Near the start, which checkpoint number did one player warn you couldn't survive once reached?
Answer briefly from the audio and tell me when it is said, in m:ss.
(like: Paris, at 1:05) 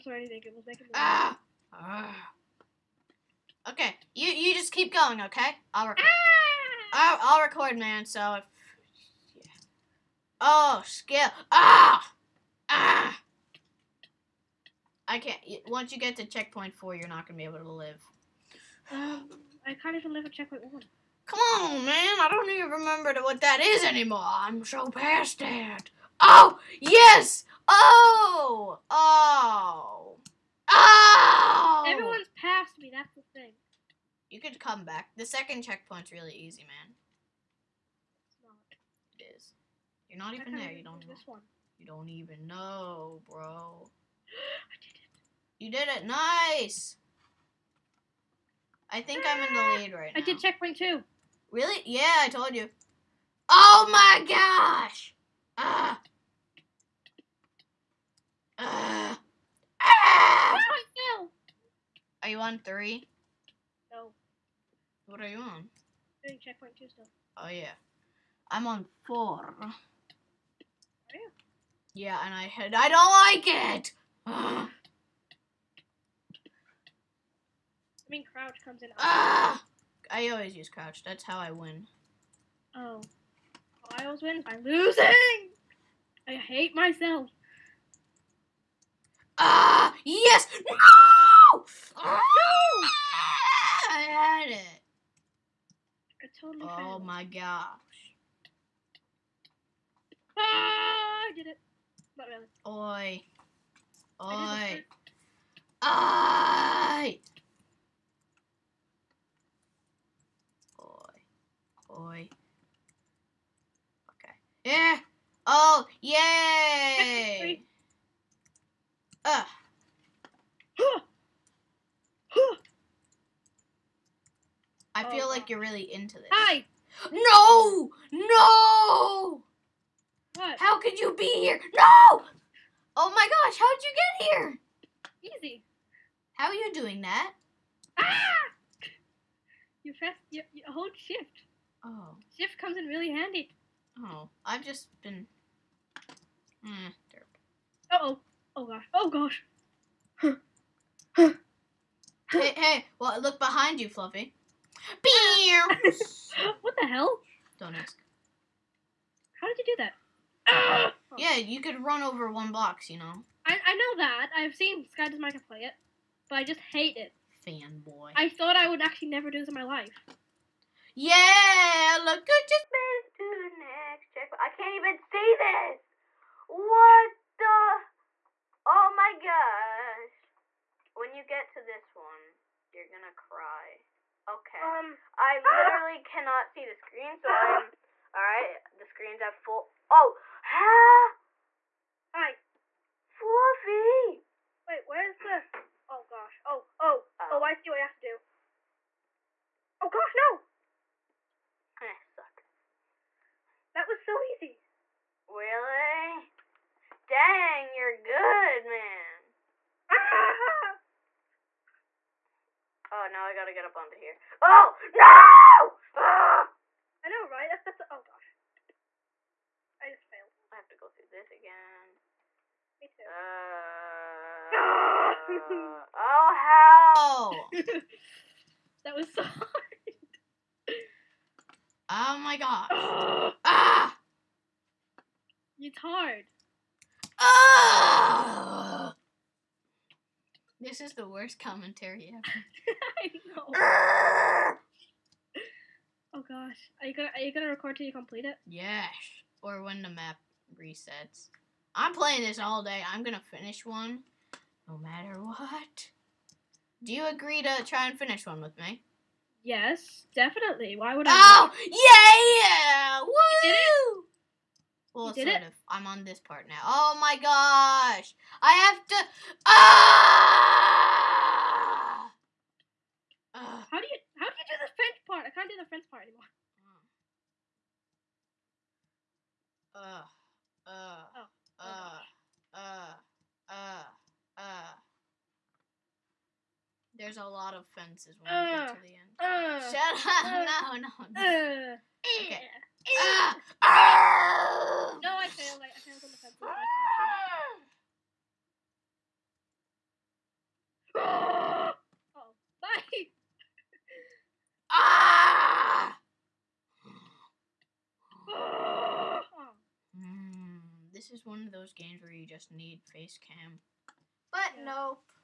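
4, at 0:16.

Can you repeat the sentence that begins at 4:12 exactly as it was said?
I'm gonna finish one, no matter what.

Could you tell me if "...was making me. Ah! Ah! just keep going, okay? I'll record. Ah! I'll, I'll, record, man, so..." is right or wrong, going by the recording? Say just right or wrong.
right.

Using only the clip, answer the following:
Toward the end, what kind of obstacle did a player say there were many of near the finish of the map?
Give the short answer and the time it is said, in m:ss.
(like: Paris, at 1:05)
Fences, at 4:47.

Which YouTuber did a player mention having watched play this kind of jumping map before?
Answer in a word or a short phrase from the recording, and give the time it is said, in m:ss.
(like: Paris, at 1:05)
SkyDoesMinecraft, at 2:44.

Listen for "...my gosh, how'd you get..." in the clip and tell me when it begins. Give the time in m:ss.
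2:13.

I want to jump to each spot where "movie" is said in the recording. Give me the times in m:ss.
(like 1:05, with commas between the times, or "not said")
not said.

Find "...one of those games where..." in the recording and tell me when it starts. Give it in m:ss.
5:11.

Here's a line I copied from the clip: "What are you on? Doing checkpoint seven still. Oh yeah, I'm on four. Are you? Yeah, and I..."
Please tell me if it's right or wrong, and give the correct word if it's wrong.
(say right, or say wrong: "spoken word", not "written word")
wrong: "two", not "seven".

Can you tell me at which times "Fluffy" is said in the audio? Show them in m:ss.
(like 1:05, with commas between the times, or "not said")
2:33, 3:13.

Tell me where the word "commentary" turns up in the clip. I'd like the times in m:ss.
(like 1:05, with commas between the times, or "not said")
4:01.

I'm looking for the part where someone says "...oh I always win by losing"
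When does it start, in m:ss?
1:23.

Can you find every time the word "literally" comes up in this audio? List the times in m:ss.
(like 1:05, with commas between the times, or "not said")
3:05.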